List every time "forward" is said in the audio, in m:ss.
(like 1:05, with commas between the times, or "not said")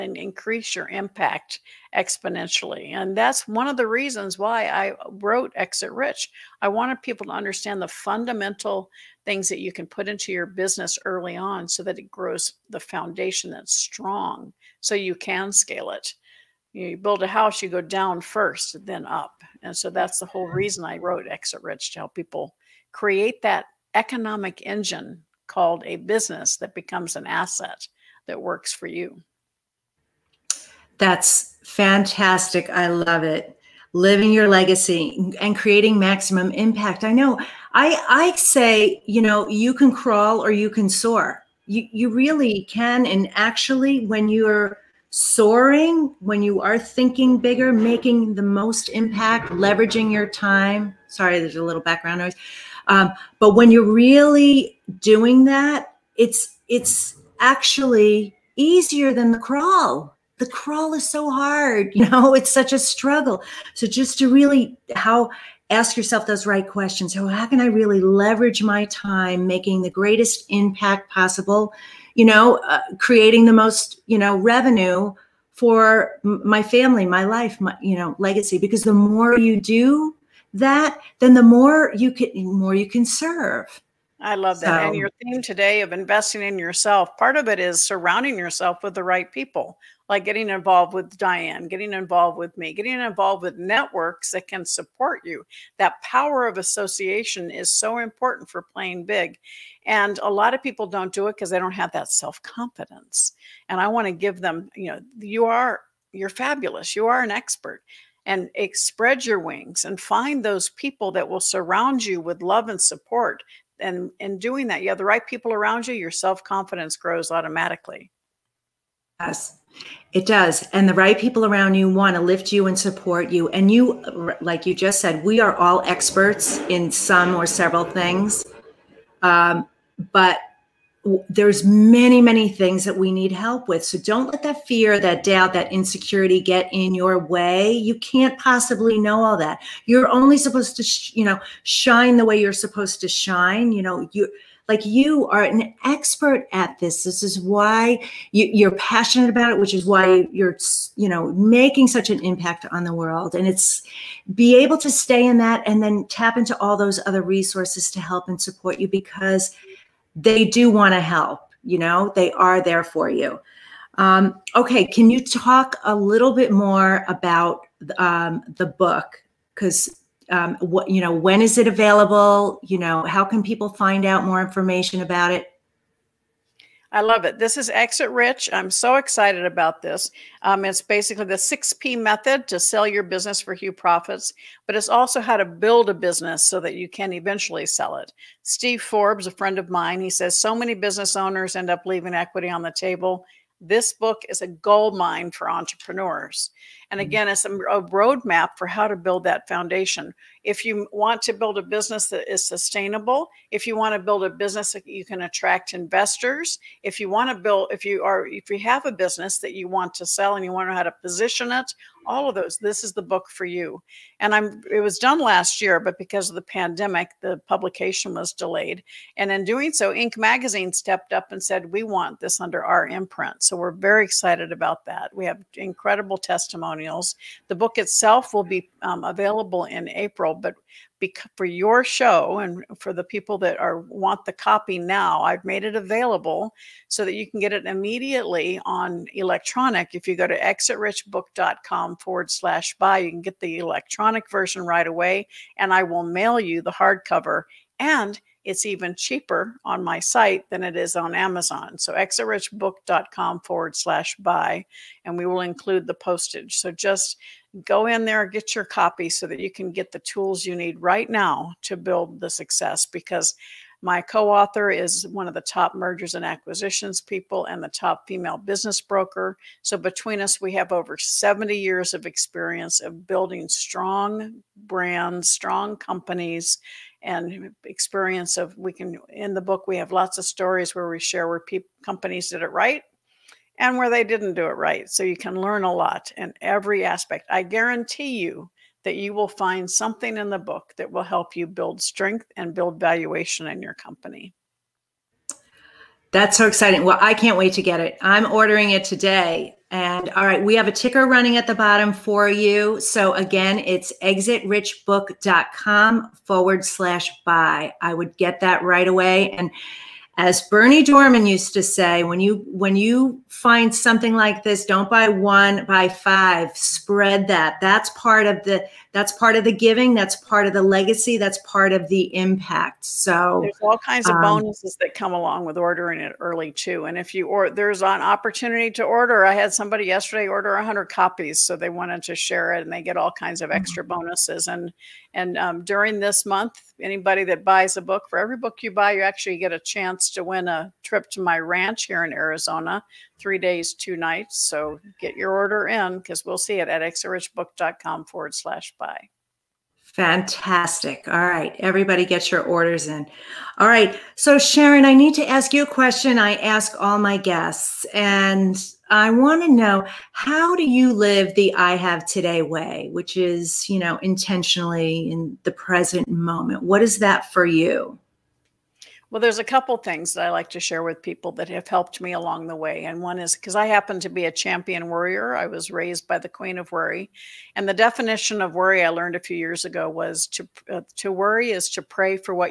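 4:01, 4:13, 5:06, 5:48.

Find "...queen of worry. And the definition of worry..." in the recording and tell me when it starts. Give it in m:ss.
6:16.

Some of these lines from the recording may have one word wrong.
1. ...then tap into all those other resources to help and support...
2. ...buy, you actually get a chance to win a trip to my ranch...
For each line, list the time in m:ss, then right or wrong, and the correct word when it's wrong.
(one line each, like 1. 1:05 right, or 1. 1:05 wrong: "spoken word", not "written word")
1. 2:35 right
2. 5:38 right.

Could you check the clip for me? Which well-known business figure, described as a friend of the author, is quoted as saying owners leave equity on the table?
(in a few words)
Steve Forbes.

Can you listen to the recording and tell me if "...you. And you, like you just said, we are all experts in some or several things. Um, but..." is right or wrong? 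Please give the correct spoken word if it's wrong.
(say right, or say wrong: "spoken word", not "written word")
right.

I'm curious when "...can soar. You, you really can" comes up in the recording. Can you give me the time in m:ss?
0:40.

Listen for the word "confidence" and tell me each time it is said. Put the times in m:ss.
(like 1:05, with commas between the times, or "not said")
1:42, 1:56.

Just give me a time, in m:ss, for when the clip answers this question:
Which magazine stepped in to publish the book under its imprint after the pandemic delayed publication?
3:39.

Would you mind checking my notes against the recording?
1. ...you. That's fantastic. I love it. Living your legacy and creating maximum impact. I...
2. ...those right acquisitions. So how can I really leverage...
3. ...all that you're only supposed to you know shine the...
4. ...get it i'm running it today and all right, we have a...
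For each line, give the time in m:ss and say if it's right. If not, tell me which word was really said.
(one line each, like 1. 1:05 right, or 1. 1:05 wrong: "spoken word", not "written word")
1. 0:28 right
2. 1:06 wrong: "questions", not "acquisitions"
3. 2:19 right
4. 4:57 wrong: "ordering", not "running".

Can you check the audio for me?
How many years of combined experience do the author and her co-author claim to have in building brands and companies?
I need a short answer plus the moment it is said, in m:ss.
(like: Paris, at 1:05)
70, at 4:30.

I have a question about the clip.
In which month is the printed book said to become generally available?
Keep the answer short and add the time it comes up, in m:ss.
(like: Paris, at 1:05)
April, at 3:49.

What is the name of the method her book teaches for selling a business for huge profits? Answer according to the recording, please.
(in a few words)
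6P method.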